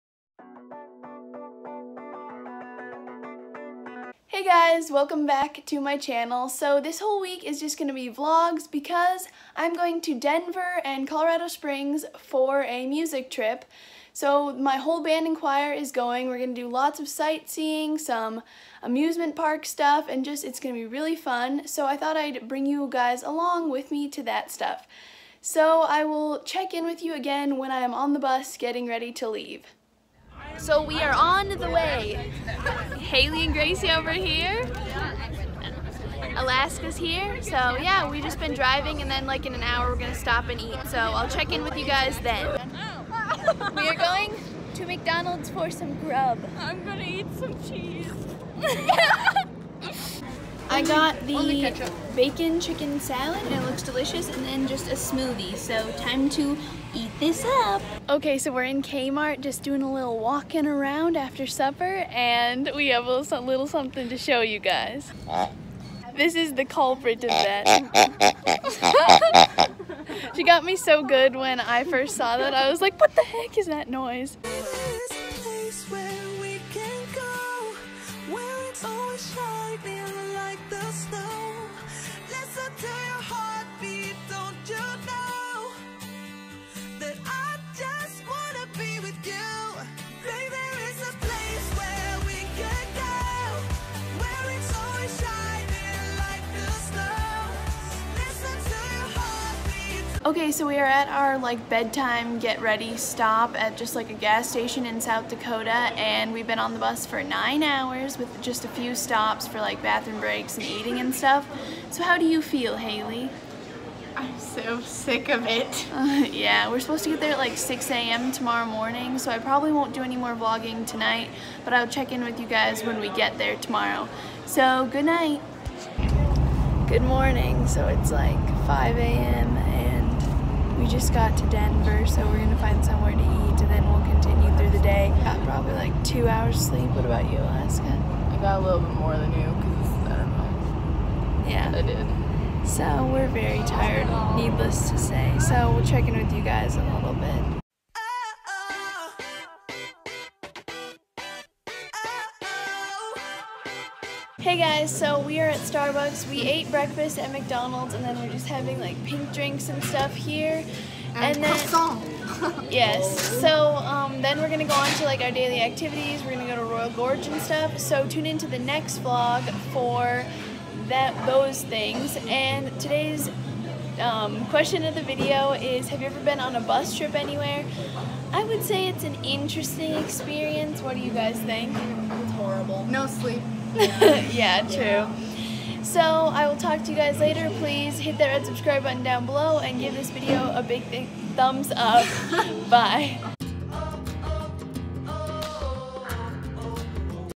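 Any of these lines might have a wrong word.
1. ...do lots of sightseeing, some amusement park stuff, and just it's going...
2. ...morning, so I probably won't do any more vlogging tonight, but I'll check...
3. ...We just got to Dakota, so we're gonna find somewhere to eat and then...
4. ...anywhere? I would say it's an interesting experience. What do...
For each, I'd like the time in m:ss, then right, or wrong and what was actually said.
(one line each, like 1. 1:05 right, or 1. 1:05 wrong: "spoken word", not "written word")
1. 0:16 right
2. 1:58 right
3. 2:10 wrong: "Denver", not "Dakota"
4. 2:57 right.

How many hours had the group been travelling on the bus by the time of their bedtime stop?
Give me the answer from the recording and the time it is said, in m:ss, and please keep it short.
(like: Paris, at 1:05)
9, at 1:47.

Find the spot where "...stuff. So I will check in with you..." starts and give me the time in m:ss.
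0:24.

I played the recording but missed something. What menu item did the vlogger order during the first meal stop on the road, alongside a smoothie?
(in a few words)
Bacon chicken salad.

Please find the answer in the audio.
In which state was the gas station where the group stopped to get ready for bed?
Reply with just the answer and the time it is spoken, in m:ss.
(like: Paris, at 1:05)
South Dakota, at 1:45.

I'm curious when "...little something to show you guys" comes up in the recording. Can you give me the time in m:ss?
1:03.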